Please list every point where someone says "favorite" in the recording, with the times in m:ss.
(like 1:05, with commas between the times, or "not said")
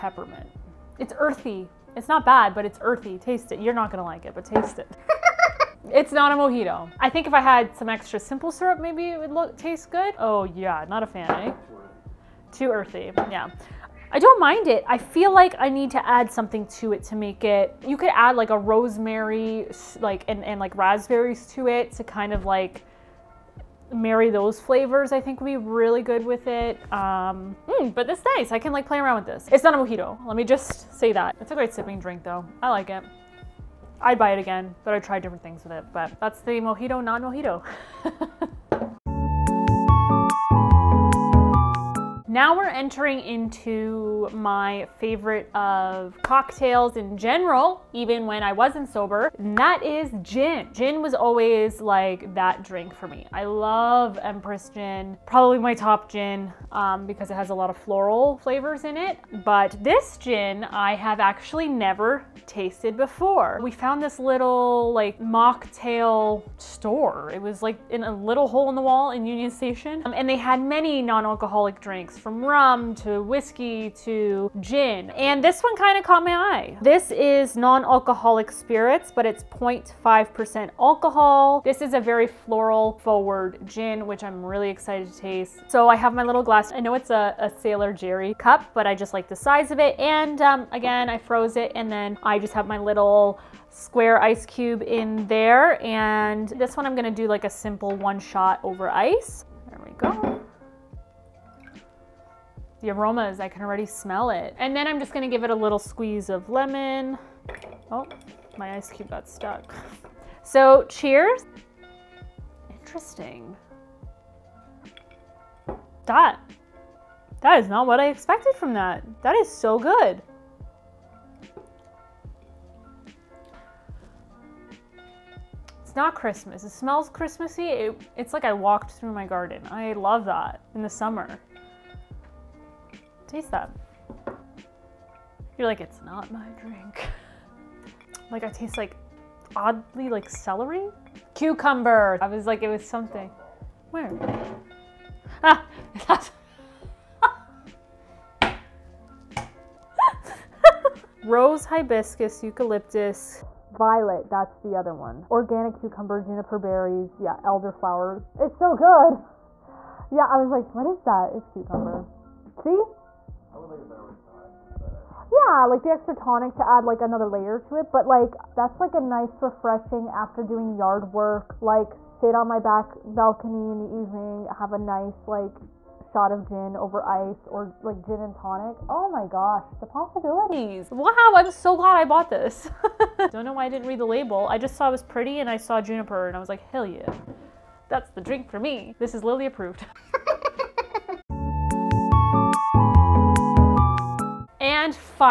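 0:44.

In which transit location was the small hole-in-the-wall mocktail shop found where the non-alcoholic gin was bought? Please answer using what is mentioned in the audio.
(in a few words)
Union Station.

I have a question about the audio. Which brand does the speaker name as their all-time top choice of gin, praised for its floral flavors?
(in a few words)
Empress Gin.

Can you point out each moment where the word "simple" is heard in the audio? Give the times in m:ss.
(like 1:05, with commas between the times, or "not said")
0:08, 1:37.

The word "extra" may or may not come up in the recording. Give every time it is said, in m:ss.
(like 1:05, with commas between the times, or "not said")
0:07, 2:45.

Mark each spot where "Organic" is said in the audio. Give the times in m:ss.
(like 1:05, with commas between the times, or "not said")
2:35.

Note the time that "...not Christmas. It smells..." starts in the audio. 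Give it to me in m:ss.
2:05.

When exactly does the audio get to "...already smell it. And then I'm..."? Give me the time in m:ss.
1:43.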